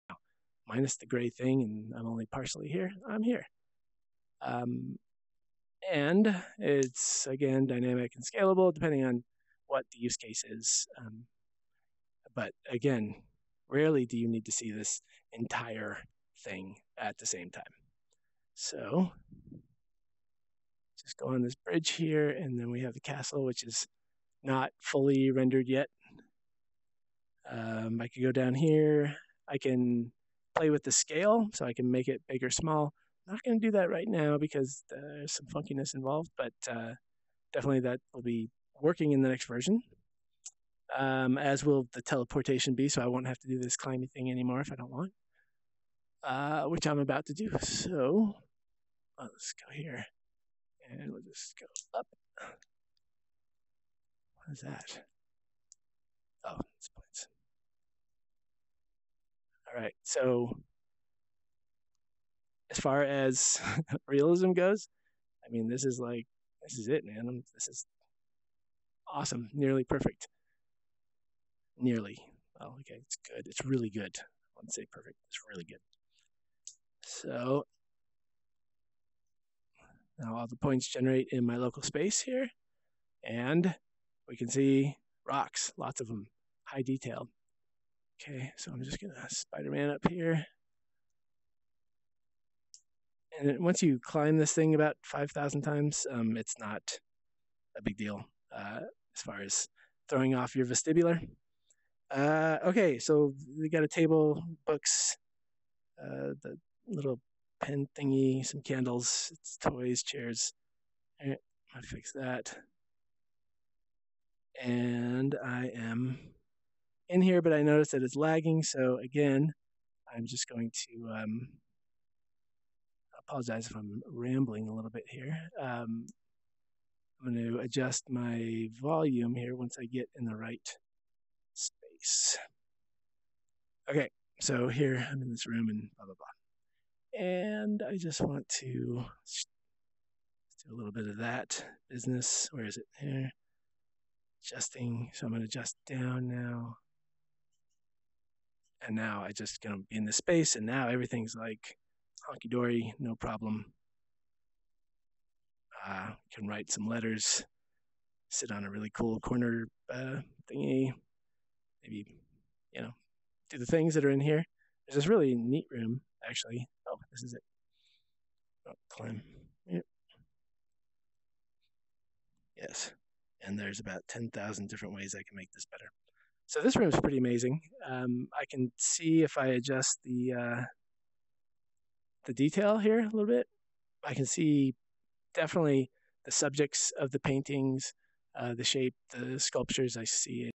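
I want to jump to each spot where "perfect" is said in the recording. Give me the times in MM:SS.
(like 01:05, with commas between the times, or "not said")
01:09, 01:14.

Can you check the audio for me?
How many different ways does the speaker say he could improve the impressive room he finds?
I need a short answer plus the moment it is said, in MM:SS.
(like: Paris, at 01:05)
10,000, at 02:54.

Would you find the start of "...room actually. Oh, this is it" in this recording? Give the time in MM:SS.
02:45.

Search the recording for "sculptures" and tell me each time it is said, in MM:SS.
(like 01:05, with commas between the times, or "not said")
03:09.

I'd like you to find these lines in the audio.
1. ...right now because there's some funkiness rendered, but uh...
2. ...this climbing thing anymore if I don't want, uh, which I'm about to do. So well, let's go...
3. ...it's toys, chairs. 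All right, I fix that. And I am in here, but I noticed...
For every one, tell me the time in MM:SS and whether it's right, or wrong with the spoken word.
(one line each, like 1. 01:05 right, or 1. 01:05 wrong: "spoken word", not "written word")
1. 00:33 wrong: "involved", not "rendered"
2. 00:43 right
3. 01:49 right.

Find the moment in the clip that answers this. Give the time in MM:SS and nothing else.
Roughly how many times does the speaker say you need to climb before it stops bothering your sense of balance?
01:35.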